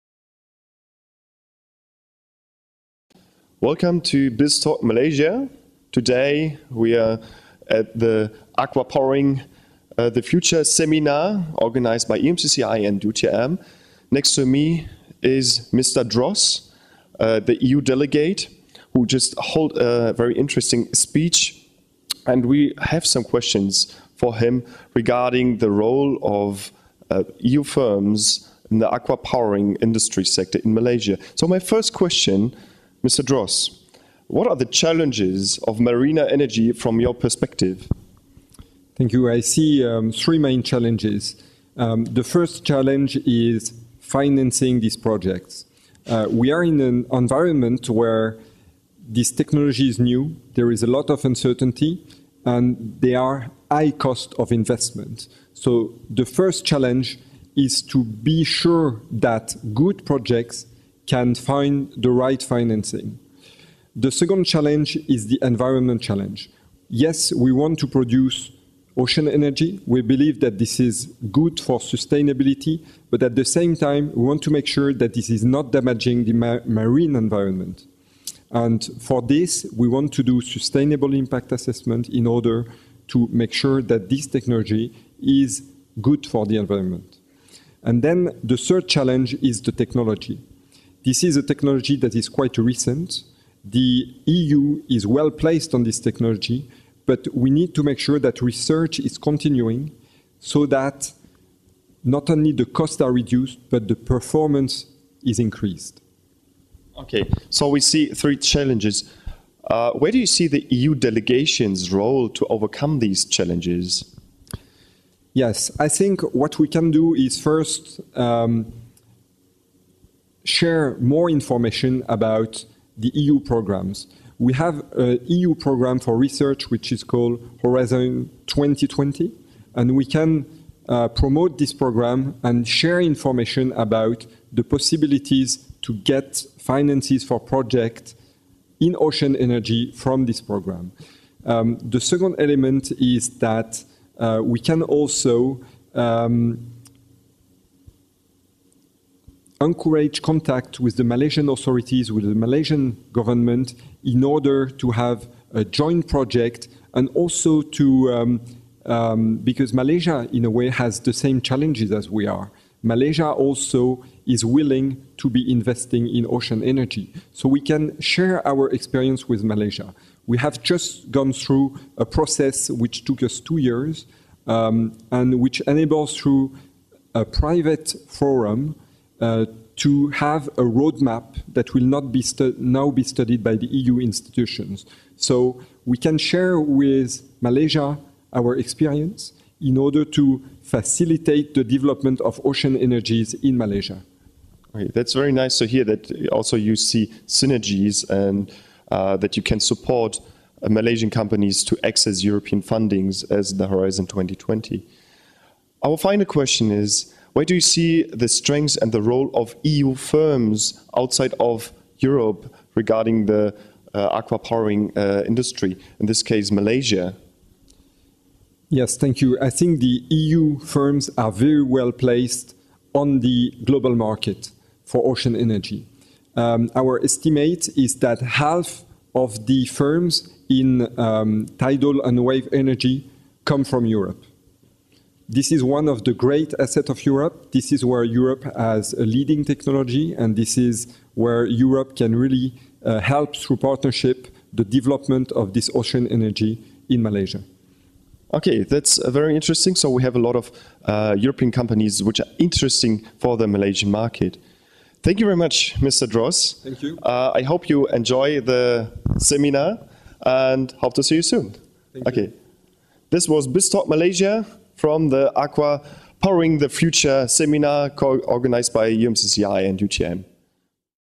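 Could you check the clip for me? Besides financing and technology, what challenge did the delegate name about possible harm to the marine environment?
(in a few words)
The environment challenge.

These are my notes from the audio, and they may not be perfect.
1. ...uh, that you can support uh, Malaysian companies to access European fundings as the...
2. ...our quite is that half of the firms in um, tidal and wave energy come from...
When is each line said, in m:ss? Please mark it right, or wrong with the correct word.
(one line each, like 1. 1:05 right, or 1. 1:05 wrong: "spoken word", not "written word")
1. 3:18 right
2. 3:46 wrong: "estimate", not "quite".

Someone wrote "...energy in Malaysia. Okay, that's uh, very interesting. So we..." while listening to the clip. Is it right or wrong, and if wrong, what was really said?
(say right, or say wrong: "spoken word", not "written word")
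right.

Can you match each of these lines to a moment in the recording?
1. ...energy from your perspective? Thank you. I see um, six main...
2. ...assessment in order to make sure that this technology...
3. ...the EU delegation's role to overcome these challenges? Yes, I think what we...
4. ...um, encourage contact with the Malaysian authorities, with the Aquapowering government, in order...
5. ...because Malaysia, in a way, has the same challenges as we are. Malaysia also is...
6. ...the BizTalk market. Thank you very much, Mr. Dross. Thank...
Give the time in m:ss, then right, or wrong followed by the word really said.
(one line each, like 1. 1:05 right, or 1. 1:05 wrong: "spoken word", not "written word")
1. 0:36 wrong: "three", not "six"
2. 1:21 right
3. 1:50 right
4. 2:25 wrong: "Malaysian", not "Aquapowering"
5. 2:39 right
6. 4:13 wrong: "Malaysian", not "BizTalk".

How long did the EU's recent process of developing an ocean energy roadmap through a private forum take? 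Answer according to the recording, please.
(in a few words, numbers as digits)
2 years.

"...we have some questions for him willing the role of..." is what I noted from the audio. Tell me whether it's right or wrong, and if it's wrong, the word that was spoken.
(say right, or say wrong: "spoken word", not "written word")
wrong: "regarding", not "willing".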